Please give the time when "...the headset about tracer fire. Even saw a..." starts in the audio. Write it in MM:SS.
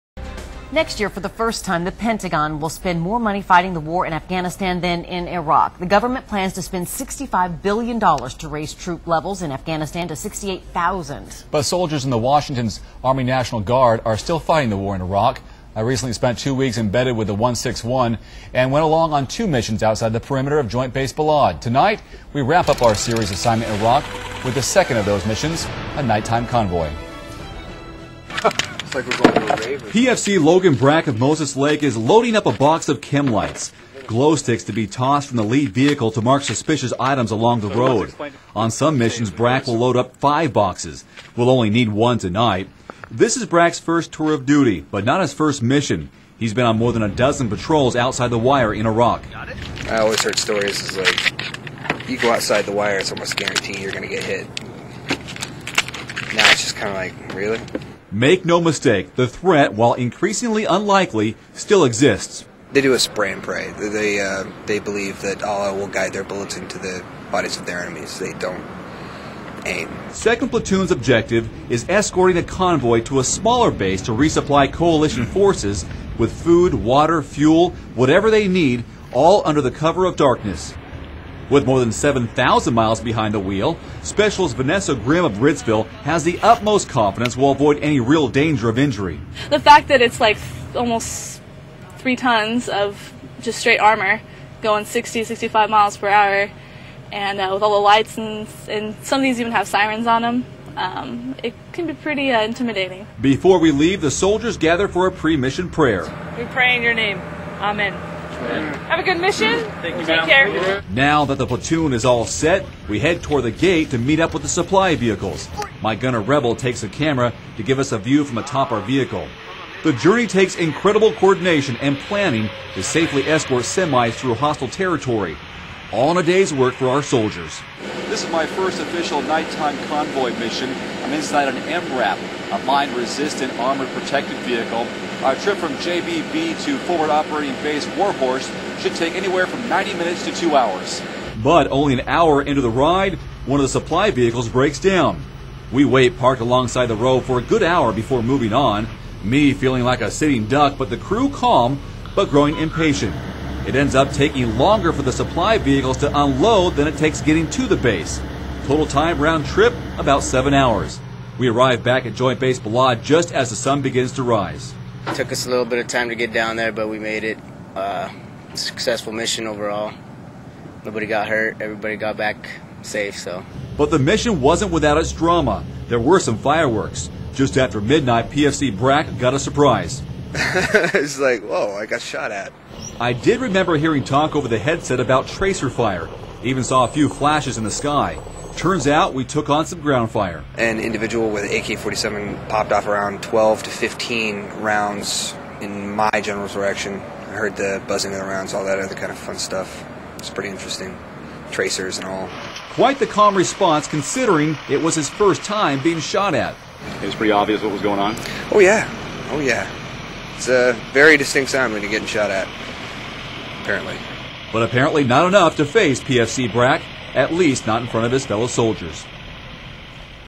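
03:04.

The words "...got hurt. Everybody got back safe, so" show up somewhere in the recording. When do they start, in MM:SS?
02:51.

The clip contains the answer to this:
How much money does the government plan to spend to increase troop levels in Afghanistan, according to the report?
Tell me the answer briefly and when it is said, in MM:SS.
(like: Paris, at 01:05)
$65 billion, at 00:06.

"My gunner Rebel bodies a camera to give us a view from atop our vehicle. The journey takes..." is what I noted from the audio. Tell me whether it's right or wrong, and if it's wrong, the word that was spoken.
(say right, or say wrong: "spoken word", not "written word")
wrong: "takes", not "bodies".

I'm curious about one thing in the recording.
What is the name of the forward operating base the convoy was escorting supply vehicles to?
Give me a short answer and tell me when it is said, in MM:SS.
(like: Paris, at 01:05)
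Warhorse, at 02:17.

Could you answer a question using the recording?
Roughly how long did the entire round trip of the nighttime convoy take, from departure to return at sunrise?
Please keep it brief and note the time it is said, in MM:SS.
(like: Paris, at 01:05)
7 hours, at 02:40.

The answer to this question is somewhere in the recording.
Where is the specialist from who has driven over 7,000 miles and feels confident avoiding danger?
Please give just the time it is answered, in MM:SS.
01:25.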